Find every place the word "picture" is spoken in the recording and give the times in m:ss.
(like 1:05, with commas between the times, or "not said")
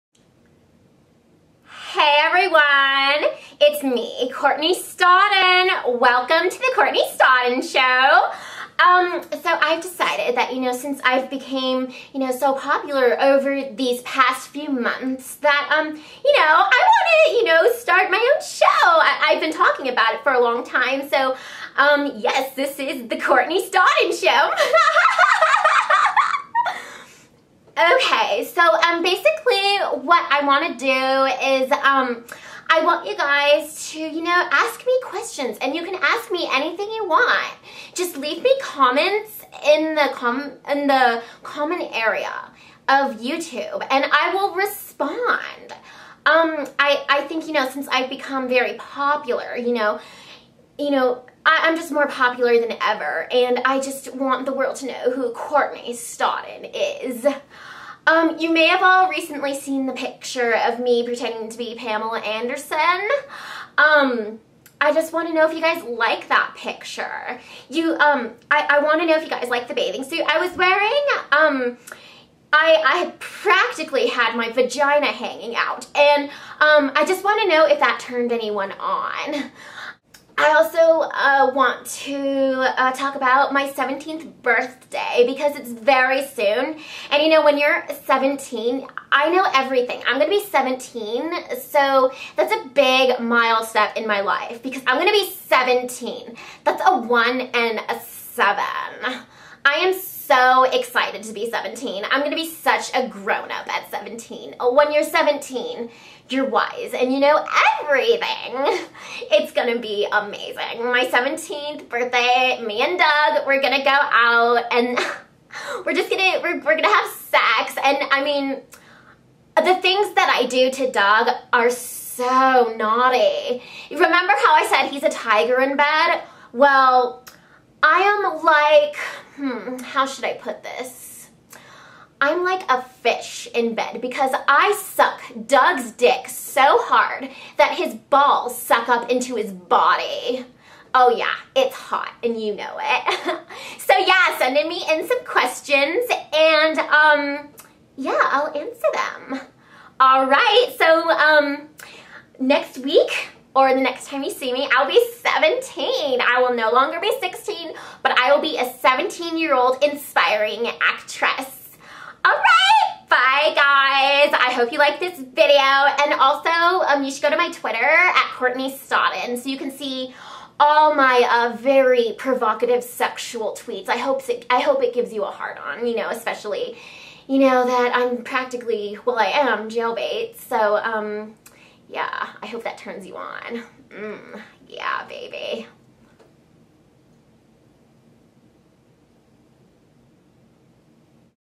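0:59, 1:06.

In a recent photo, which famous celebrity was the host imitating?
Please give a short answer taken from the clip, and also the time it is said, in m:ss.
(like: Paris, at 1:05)
Pamela Anderson, at 1:01.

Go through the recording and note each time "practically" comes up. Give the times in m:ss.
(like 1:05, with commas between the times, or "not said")
1:13, 2:58.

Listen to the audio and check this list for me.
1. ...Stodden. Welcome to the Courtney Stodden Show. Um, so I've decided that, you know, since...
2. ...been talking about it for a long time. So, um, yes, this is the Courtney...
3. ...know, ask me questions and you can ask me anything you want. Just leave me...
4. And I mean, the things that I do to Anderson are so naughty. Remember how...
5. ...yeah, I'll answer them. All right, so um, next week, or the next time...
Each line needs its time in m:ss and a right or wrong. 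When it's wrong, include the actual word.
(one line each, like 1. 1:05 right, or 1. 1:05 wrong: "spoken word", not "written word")
1. 0:04 right
2. 0:19 right
3. 0:34 right
4. 1:57 wrong: "Doug", not "Anderson"
5. 2:27 right.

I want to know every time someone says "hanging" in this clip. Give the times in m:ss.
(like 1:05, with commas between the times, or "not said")
1:15.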